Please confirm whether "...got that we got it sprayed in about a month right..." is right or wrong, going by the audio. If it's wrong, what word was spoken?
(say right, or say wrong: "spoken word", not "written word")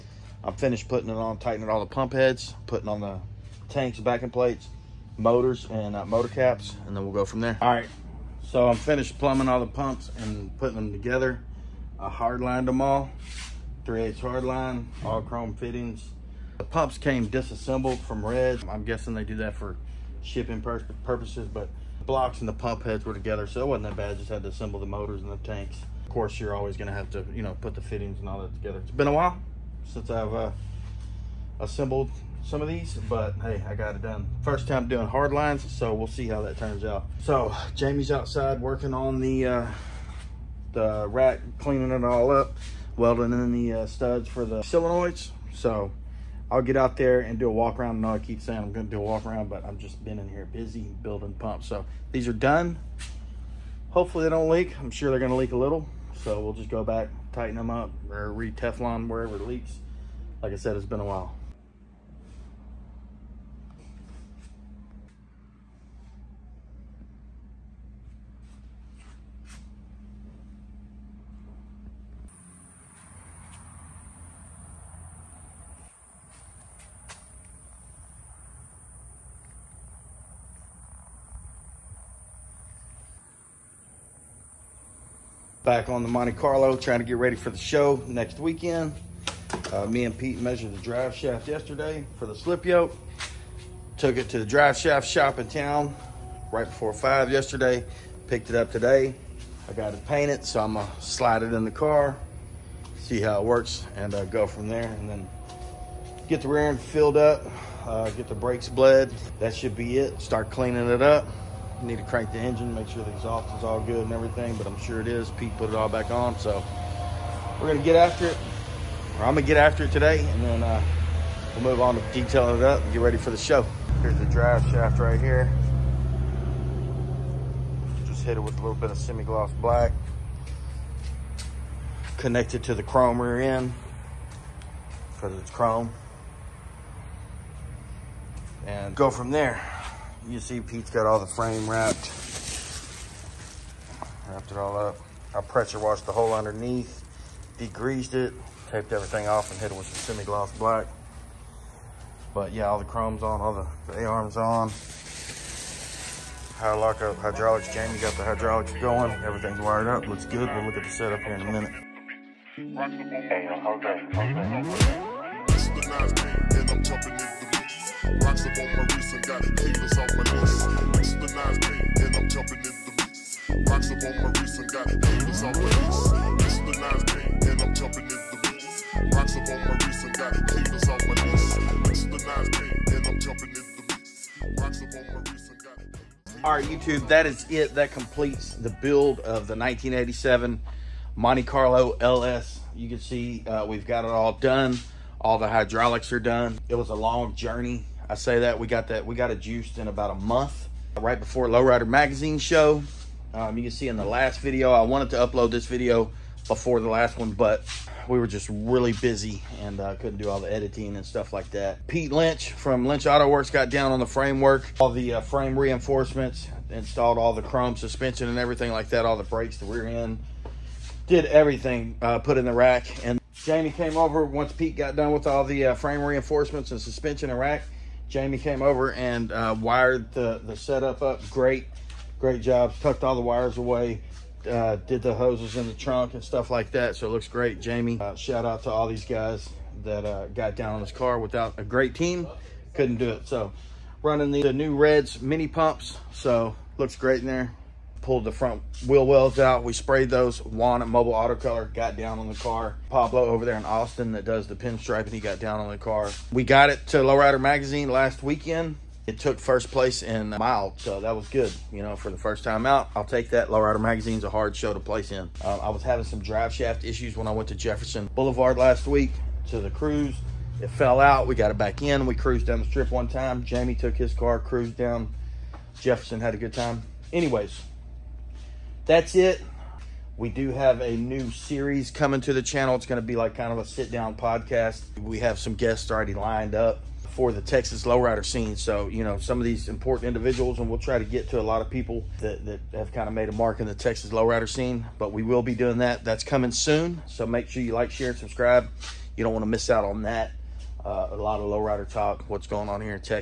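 wrong: "juiced", not "sprayed".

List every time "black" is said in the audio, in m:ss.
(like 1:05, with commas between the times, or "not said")
2:09, 2:30.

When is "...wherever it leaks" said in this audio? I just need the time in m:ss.
0:59.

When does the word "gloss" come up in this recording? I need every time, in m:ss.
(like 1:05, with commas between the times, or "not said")
2:08, 2:30.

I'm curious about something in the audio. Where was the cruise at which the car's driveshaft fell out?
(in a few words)
Jefferson Boulevard.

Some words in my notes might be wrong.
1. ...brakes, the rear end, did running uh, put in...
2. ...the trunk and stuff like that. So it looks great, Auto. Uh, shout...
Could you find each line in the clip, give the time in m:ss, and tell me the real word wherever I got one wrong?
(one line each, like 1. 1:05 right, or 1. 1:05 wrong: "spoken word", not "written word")
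1. 3:39 wrong: "everything", not "running"
2. 3:55 wrong: "Jamie", not "Auto".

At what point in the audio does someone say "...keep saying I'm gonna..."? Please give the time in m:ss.
0:48.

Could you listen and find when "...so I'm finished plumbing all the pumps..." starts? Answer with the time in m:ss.
0:08.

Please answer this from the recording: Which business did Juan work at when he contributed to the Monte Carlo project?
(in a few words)
Mobile Auto Color.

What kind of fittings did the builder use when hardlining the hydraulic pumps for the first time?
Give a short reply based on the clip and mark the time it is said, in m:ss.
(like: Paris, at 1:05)
Chrome fittings, at 0:15.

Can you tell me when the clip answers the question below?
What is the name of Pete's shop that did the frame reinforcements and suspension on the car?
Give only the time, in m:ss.
3:32.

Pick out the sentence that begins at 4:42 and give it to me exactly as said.
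It's going to be like kind of a sit down podcast.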